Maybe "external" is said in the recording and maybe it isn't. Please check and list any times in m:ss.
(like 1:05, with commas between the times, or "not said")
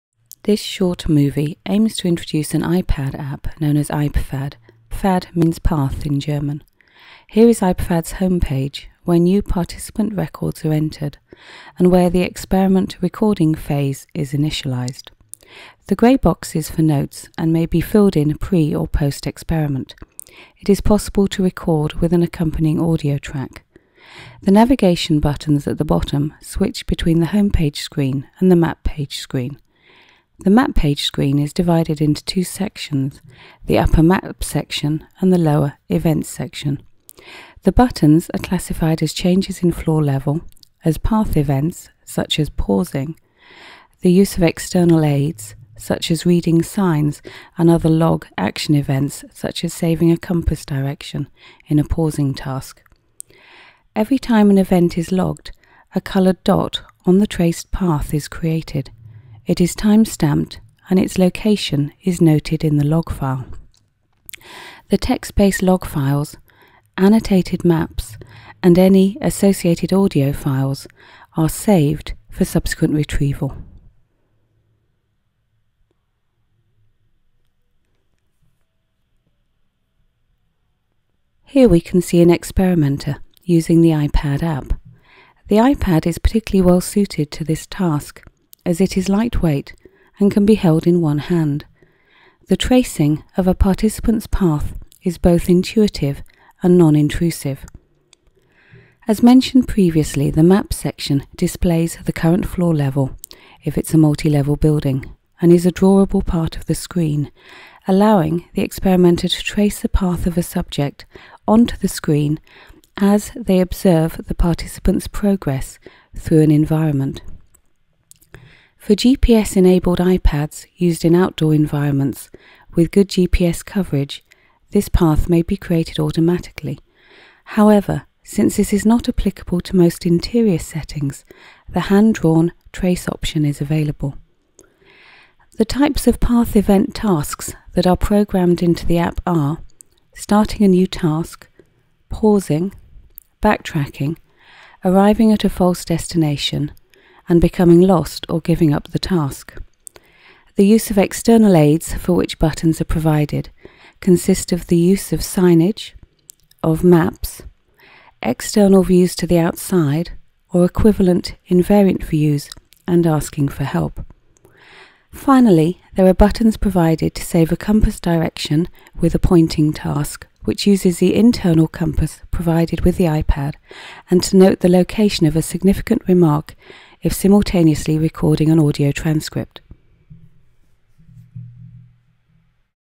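0:44, 2:30, 2:38.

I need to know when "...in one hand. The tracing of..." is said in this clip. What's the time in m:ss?
1:30.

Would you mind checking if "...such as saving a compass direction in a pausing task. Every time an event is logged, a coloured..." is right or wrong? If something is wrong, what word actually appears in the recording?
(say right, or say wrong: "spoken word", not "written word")
right.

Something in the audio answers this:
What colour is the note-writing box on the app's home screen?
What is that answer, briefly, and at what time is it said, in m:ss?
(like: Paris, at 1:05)
grey, at 0:15.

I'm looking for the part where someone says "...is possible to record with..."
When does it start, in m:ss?
0:20.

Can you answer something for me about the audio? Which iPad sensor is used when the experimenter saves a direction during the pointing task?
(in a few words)
internal compass.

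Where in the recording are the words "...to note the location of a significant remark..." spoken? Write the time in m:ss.
2:54.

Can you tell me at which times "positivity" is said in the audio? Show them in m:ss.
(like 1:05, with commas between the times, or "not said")
not said.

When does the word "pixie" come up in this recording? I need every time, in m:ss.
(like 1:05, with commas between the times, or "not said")
not said.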